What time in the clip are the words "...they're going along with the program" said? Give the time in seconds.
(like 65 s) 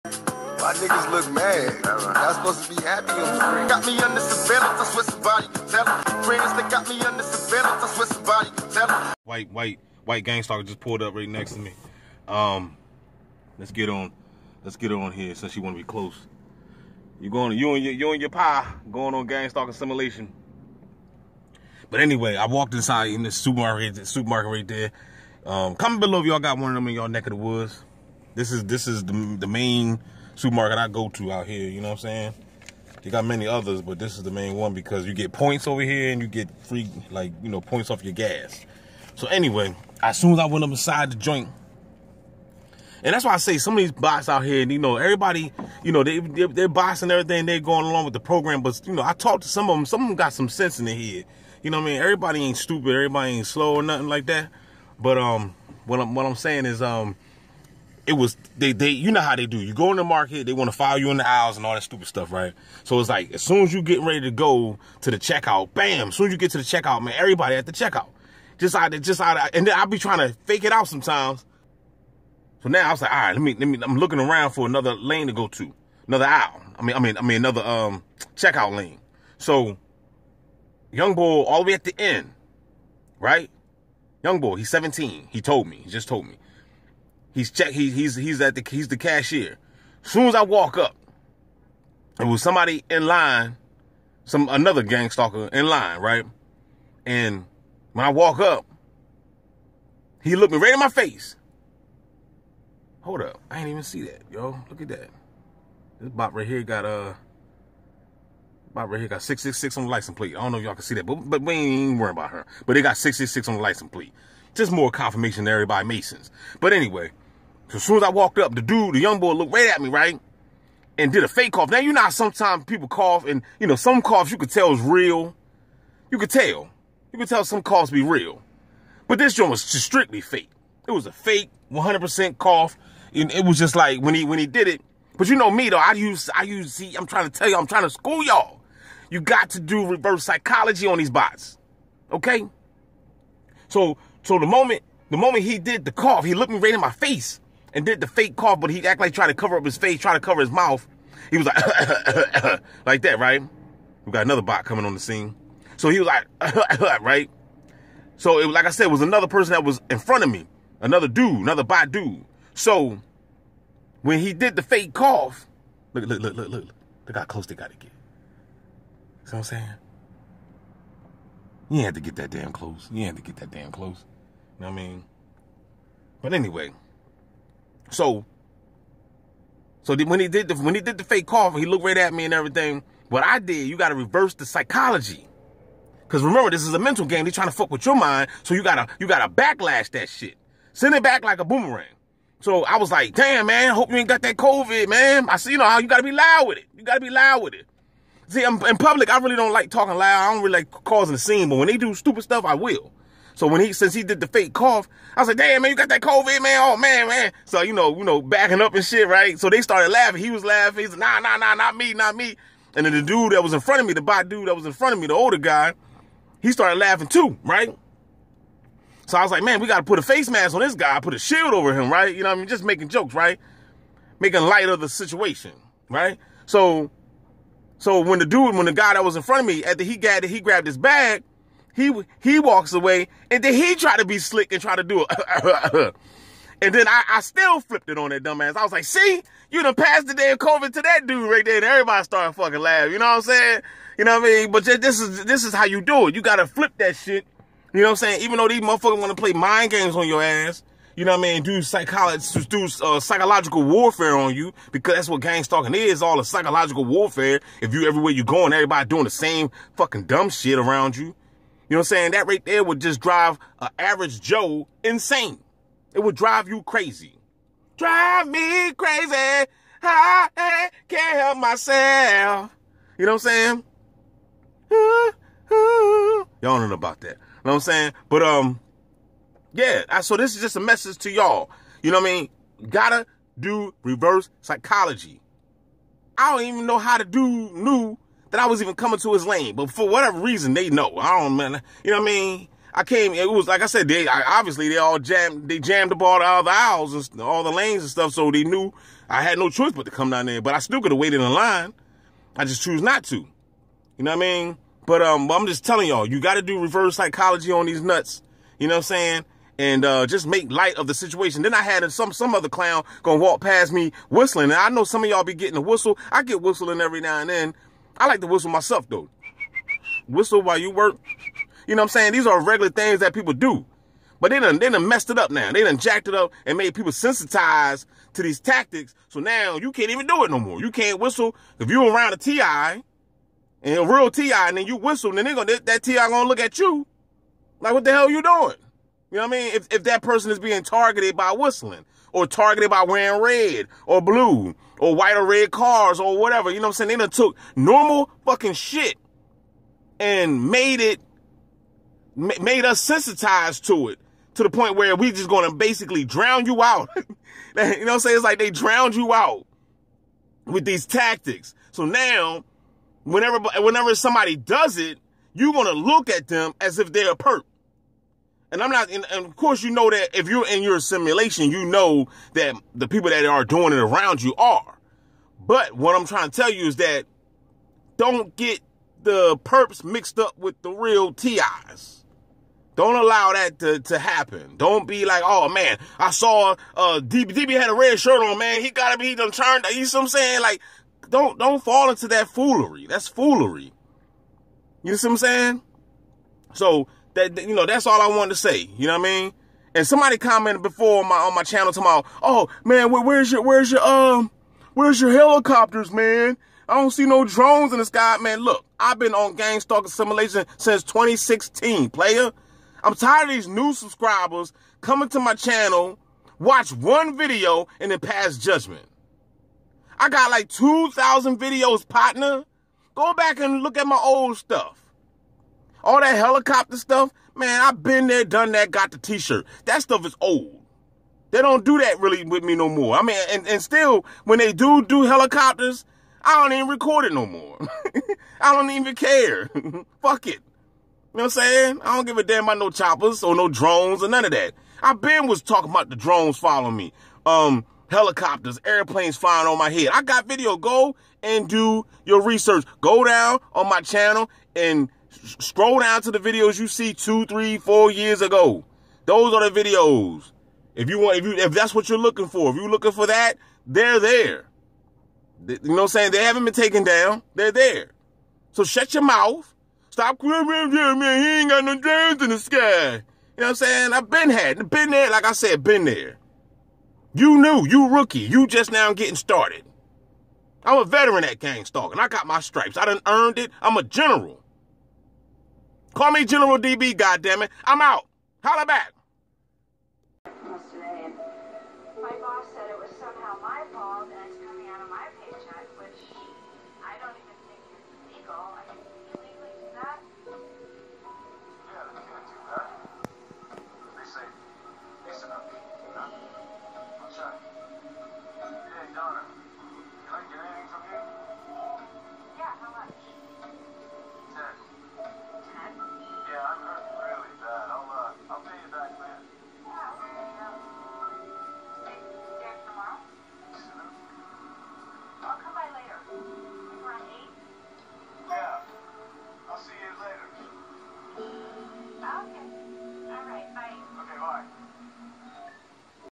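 47 s.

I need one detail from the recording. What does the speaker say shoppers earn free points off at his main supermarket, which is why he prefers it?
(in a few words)
gas.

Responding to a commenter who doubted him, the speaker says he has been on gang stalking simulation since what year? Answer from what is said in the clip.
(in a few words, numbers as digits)
2016.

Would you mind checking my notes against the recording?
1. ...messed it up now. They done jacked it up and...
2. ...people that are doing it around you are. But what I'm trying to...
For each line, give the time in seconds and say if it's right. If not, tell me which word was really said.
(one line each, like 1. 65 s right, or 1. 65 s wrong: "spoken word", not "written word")
1. 324 s right
2. 372 s right.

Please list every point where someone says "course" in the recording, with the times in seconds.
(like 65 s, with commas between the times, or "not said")
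369 s.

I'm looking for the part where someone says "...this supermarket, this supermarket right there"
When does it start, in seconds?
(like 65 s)
23 s.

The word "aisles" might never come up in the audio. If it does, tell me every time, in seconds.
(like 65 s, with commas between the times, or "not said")
61 s, 76 s, 296 s.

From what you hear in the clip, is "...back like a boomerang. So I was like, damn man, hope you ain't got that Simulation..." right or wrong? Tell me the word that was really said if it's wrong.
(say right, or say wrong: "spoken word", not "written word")
wrong: "COVID", not "Simulation".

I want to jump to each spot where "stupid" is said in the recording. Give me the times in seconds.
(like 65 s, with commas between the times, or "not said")
52 s, 61 s, 201 s.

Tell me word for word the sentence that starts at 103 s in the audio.
Hold up, I ain't even see that, yo.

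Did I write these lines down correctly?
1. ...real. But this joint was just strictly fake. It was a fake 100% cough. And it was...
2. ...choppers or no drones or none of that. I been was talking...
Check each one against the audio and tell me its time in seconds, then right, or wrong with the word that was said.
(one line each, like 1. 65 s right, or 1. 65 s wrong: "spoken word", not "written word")
1. 128 s right
2. 442 s right.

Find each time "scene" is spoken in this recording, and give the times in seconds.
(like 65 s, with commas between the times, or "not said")
154 s, 201 s.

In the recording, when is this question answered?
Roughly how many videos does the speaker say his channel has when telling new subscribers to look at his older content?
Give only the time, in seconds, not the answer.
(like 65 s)
420 s.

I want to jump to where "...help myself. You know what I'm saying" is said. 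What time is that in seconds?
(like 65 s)
271 s.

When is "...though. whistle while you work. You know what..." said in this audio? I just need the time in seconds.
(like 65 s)
318 s.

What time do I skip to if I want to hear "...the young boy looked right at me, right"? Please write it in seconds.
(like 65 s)
118 s.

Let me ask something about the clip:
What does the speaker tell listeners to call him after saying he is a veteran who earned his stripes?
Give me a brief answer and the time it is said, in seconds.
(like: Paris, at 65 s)
General DB, at 486 s.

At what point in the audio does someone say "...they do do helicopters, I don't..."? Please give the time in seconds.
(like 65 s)
434 s.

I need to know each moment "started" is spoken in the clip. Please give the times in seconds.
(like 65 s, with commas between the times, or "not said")
209 s, 216 s, 242 s, 479 s.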